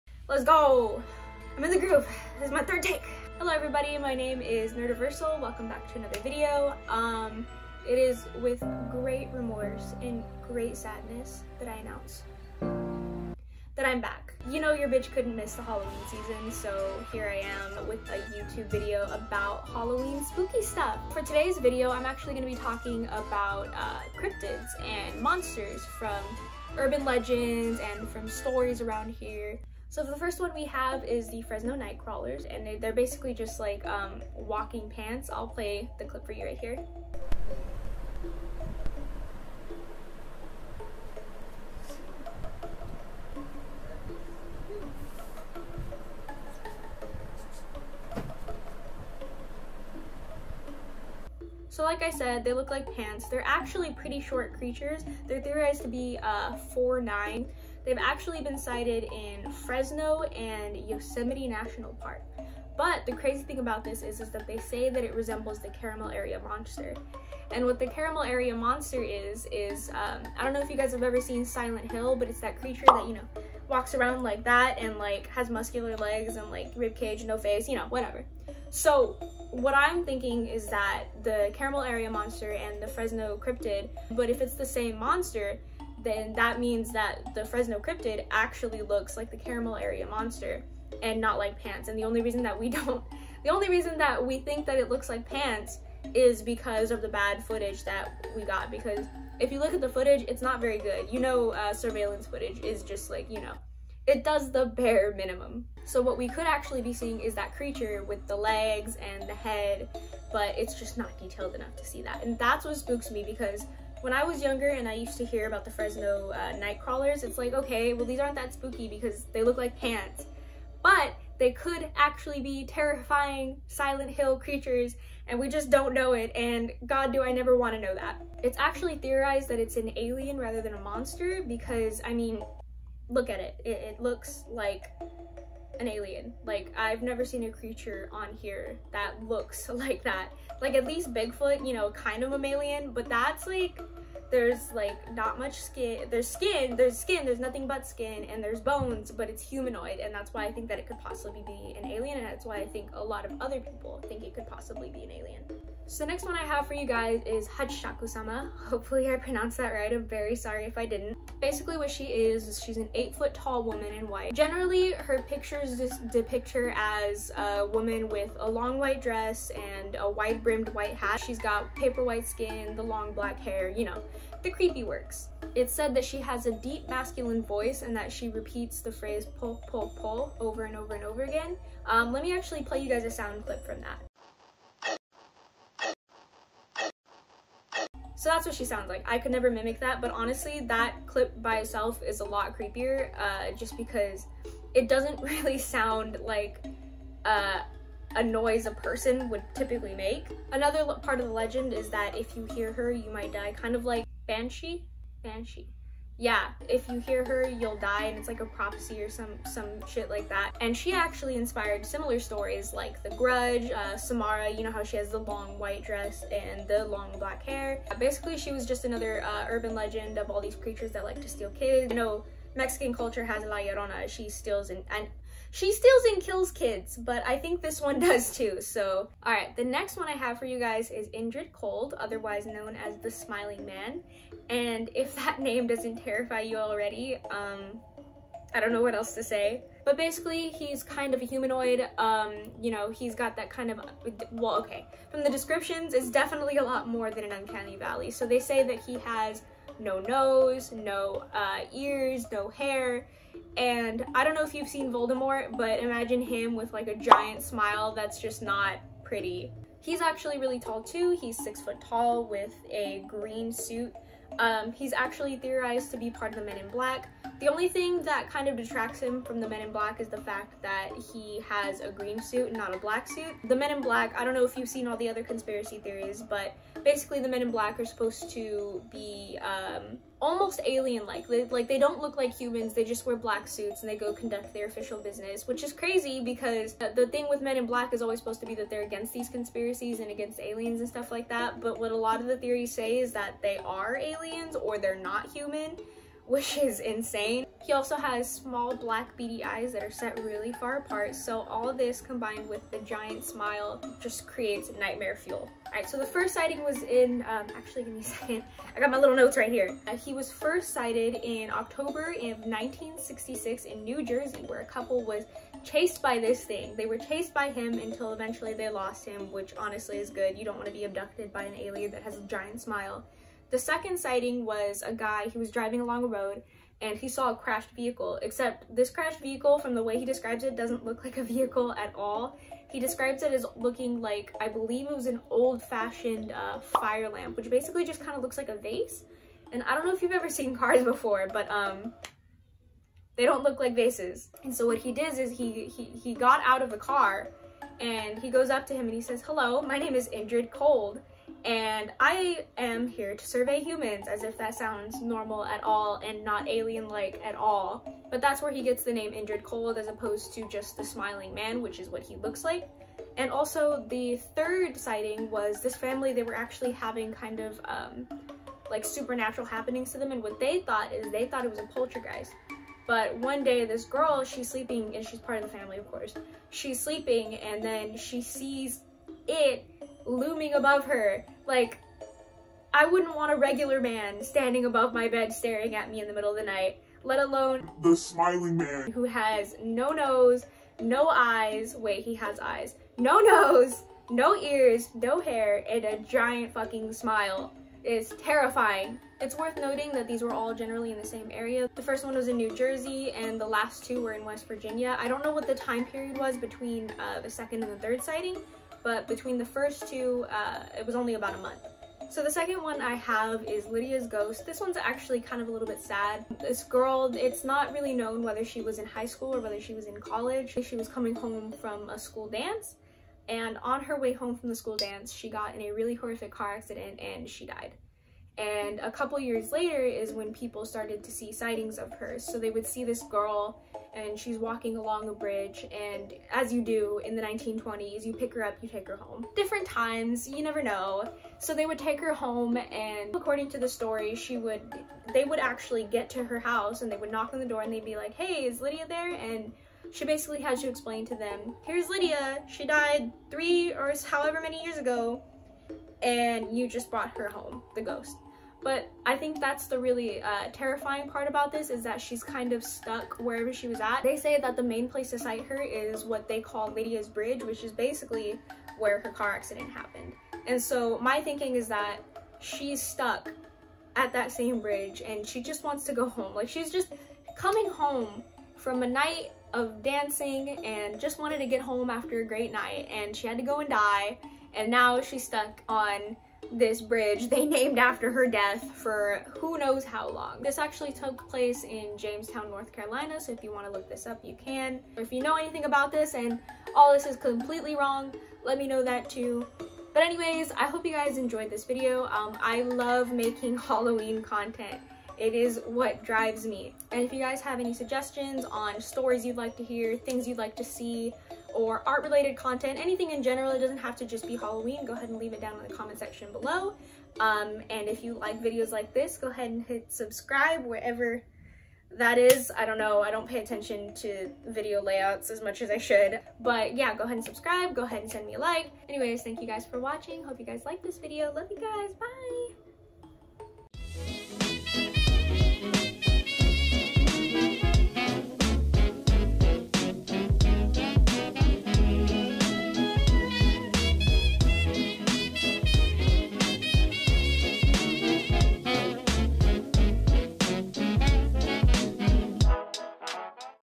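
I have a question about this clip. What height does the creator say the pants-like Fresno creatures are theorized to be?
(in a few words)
4'9".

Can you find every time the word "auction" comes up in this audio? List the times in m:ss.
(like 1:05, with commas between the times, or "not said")
not said.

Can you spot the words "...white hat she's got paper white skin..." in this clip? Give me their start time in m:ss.
2:50.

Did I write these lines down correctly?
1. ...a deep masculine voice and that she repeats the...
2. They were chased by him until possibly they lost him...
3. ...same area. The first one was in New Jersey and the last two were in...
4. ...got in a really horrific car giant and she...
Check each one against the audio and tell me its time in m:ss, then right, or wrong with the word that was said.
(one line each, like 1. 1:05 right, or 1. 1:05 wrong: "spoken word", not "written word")
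1. 2:56 right
2. 5:16 wrong: "eventually", not "possibly"
3. 6:41 right
4. 7:05 wrong: "accident", not "giant".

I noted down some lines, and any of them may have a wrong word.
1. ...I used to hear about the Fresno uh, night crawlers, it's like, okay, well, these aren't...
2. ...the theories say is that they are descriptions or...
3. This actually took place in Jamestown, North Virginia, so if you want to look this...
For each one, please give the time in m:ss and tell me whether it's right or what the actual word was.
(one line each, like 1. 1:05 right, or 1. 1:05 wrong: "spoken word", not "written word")
1. 1:54 right
2. 4:52 wrong: "aliens", not "descriptions"
3. 8:10 wrong: "Carolina", not "Virginia".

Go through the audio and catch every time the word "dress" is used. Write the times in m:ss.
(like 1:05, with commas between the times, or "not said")
2:49, 3:35.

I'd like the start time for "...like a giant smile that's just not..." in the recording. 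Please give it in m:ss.
4:16.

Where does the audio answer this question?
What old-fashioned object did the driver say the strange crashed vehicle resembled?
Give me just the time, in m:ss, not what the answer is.
5:36.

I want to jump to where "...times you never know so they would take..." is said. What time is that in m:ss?
7:19.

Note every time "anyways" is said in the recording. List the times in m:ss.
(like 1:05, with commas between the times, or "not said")
8:20, 8:48.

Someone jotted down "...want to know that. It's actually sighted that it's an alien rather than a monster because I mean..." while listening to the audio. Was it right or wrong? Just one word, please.
wrong.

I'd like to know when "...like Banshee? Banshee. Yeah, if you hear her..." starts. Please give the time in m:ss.
3:23.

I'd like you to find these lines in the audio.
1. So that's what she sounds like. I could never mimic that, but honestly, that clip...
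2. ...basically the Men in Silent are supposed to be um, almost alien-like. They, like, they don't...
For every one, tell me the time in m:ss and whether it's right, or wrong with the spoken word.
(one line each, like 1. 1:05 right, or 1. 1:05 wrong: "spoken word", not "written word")
1. 3:08 right
2. 4:36 wrong: "Black", not "Silent".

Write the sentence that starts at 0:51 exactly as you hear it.
So like I said, they look like pants.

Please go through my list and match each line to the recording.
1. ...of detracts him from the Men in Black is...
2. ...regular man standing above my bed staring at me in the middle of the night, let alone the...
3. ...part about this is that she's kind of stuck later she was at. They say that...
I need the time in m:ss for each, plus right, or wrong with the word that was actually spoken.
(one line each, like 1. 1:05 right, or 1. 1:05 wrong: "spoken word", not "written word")
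1. 4:28 right
2. 6:23 right
3. 7:41 wrong: "wherever", not "later".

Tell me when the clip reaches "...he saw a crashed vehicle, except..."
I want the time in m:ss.
5:26.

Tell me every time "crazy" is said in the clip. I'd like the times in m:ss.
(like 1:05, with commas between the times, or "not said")
1:03, 4:45.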